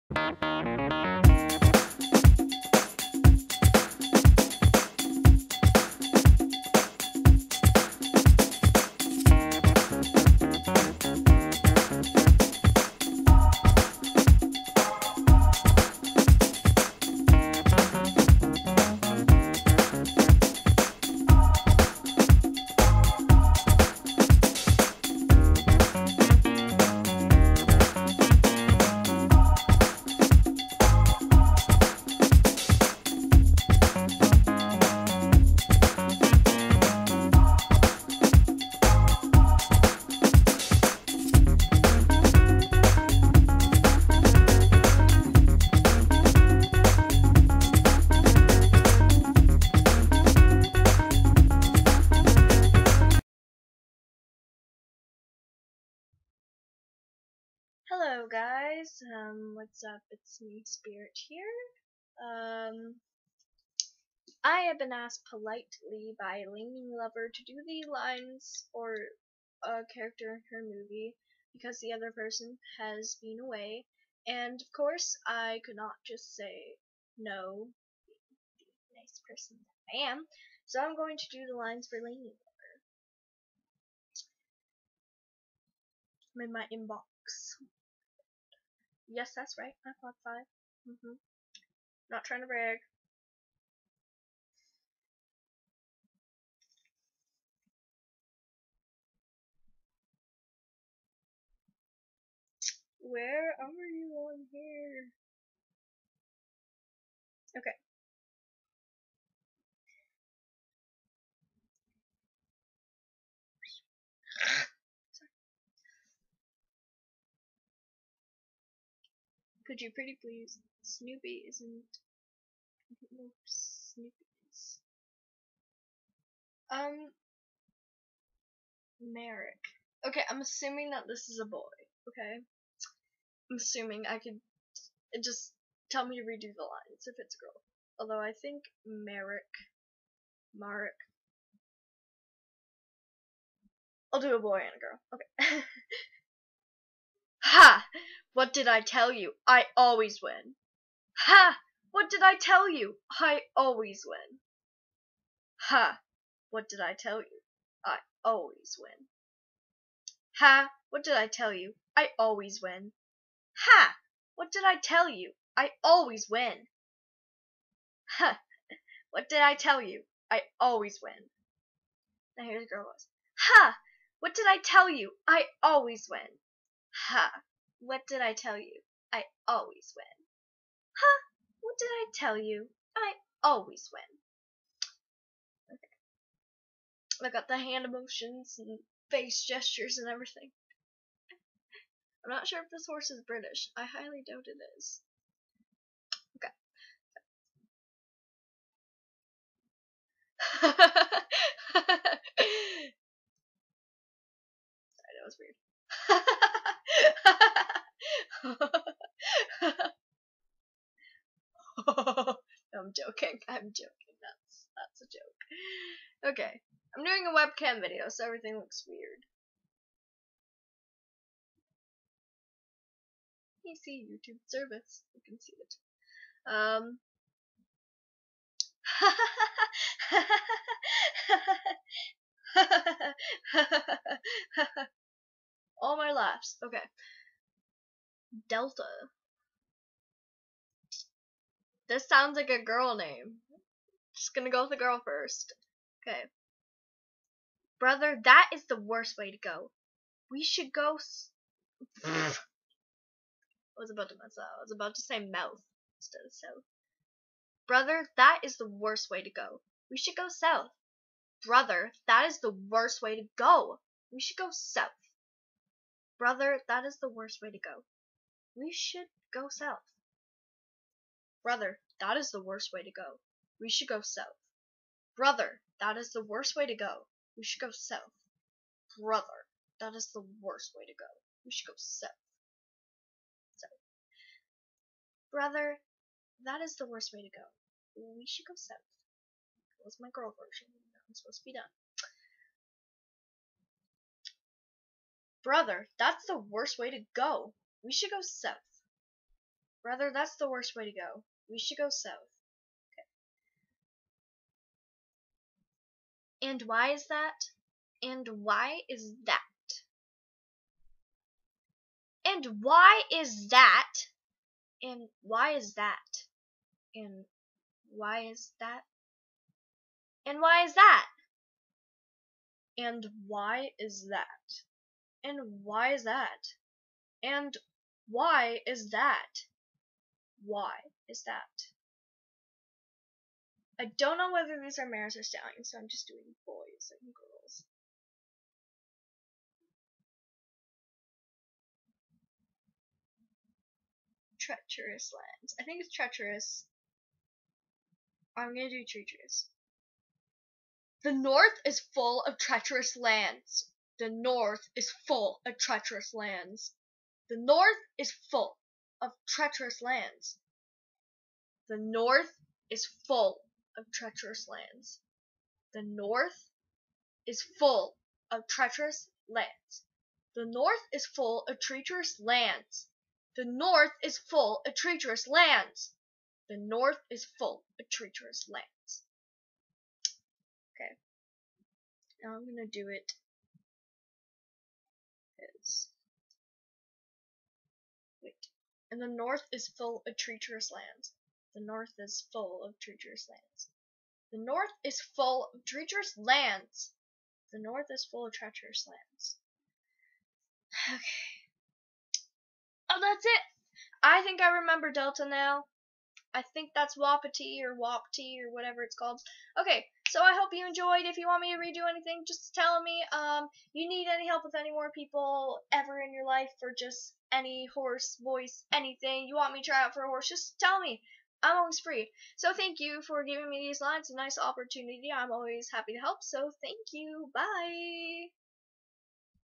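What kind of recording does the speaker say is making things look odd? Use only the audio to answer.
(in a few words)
webcam video.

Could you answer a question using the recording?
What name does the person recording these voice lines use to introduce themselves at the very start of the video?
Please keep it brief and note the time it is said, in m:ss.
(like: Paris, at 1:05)
Spirit, at 1:00.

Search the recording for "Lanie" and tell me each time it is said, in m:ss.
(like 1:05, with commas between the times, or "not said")
1:06, 1:21.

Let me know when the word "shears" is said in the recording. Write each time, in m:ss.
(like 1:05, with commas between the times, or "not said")
not said.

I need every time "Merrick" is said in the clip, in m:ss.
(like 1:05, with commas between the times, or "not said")
2:08, 2:18.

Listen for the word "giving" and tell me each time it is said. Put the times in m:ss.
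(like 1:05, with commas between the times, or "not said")
7:03.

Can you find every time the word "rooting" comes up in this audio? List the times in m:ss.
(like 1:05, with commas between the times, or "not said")
not said.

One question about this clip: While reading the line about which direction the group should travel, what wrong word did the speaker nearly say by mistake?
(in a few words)
mouth.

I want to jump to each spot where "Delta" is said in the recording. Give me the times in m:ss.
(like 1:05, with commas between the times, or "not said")
3:58, 6:44.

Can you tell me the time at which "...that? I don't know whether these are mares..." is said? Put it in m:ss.
5:31.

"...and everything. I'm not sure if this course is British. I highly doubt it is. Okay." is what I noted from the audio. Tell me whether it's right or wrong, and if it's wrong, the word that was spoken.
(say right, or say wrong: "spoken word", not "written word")
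wrong: "horse", not "course".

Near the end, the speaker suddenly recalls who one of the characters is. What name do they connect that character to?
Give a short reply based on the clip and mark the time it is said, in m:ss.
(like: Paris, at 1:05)
Wapiti, at 6:46.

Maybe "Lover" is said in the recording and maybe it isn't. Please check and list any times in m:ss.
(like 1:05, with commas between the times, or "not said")
1:06, 1:26.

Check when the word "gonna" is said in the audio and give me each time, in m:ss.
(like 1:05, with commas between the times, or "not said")
4:04, 5:48, 6:22.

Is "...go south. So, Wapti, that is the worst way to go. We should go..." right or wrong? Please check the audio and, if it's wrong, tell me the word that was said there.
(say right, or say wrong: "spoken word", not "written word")
wrong: "Brother", not "Wapti".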